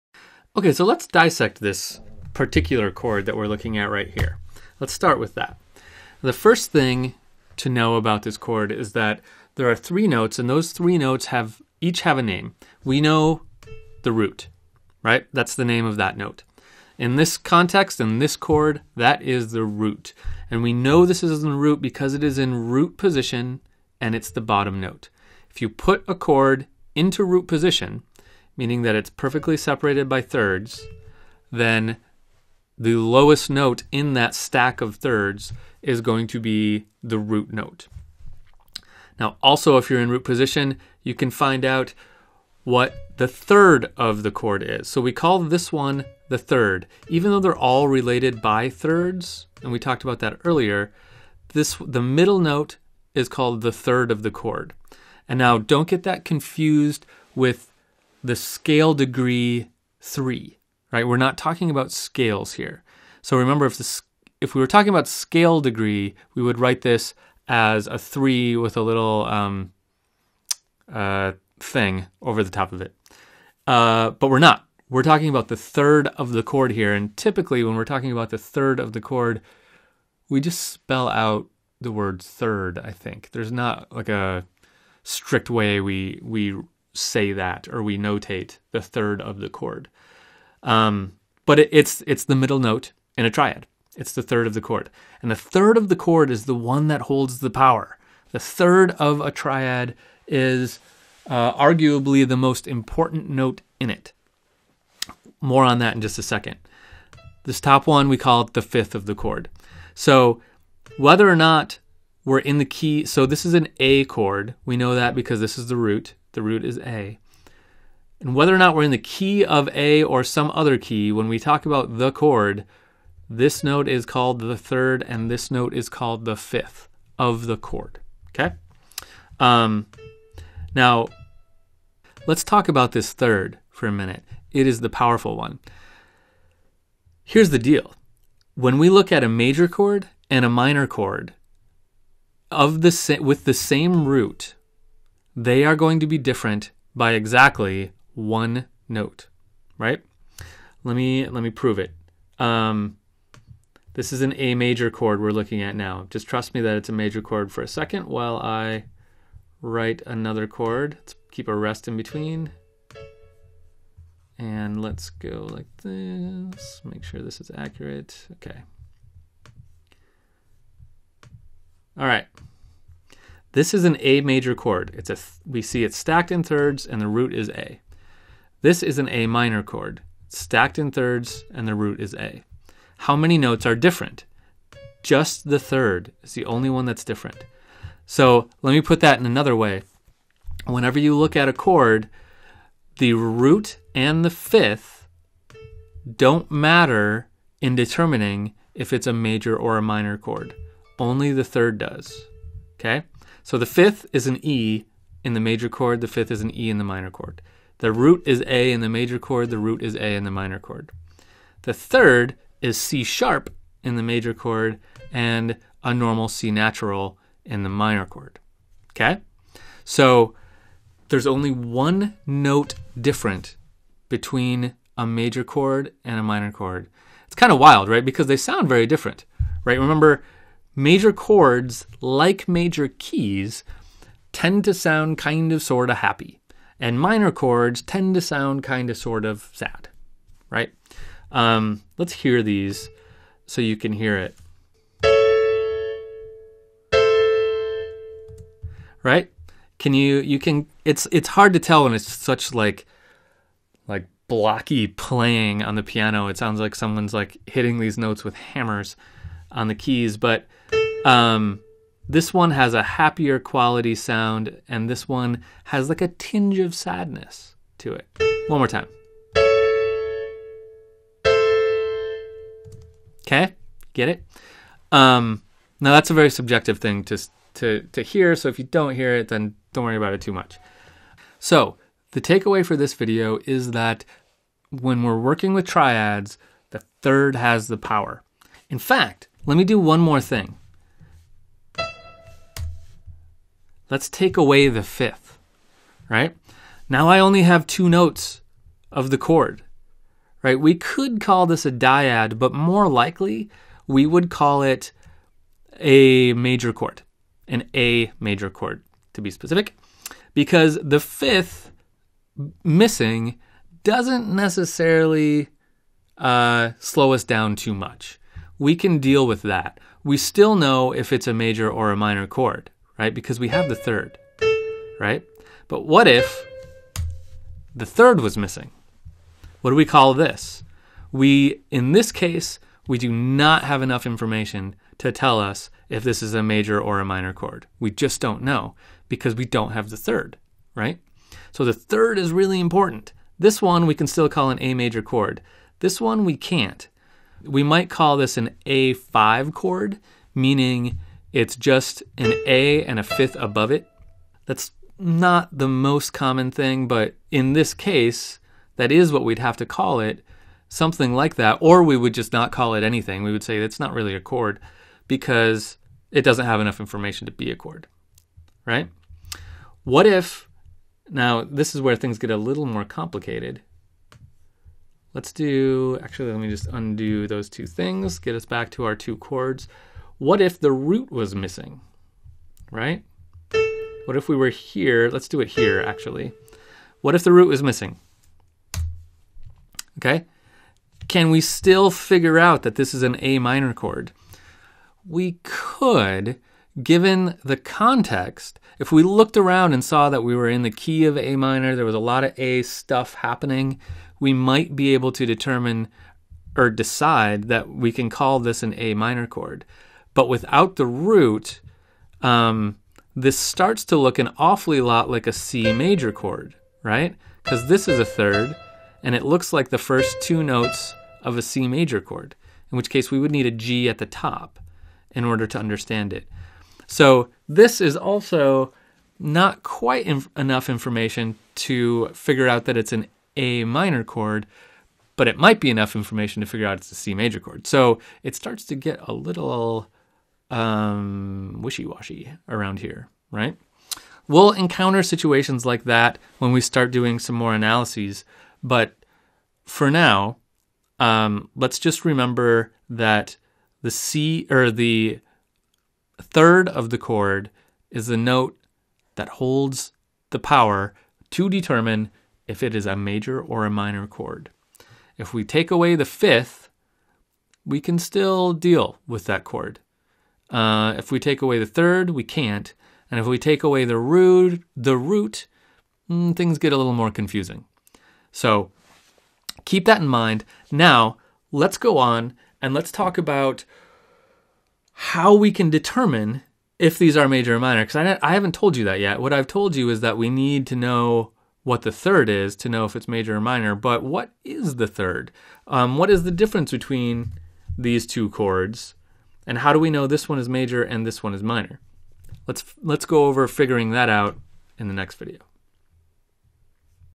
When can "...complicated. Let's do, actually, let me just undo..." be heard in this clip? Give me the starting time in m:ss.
6:12.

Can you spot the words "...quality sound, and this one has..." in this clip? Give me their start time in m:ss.
4:23.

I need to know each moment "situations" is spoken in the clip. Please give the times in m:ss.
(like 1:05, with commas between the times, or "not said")
7:25.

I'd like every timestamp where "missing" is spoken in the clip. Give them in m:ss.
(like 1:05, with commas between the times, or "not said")
5:12, 5:28, 6:21, 6:27.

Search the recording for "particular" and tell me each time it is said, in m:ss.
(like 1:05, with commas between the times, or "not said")
0:02.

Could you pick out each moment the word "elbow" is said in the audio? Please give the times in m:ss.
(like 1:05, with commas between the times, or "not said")
not said.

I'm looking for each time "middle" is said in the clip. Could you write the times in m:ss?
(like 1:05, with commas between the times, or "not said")
0:52, 1:32.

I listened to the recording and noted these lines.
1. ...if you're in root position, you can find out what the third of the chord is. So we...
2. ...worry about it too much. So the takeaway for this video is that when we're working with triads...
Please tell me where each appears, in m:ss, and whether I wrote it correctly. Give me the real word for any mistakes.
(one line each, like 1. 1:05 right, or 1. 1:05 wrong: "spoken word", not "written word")
1. 0:39 right
2. 4:39 right.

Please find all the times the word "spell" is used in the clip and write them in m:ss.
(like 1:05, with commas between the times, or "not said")
1:20.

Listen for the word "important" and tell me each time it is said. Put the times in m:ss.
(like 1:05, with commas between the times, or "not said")
1:42, 5:42.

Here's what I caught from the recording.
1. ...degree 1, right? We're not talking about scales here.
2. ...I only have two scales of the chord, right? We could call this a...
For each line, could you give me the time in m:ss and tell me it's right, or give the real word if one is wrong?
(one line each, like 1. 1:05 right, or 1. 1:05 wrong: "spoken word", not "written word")
1. 0:58 wrong: "3", not "1"
2. 4:57 wrong: "notes", not "scales".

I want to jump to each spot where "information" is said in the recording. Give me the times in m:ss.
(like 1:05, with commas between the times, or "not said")
5:34, 6:06, 7:10, 7:15.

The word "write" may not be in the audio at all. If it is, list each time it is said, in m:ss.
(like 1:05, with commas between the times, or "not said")
1:06, 2:39.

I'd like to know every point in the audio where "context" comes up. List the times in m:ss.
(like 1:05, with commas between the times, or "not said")
0:17, 6:37.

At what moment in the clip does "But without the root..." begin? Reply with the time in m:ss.
6:50.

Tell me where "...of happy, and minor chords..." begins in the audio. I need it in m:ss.
3:55.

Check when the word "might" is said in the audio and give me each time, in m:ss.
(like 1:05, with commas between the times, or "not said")
5:47, 6:44, 7:15.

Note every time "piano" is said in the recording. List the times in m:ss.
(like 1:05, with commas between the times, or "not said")
4:15.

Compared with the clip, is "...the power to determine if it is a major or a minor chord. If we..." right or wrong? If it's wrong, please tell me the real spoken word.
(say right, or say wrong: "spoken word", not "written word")
right.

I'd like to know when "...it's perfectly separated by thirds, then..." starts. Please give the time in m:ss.
0:28.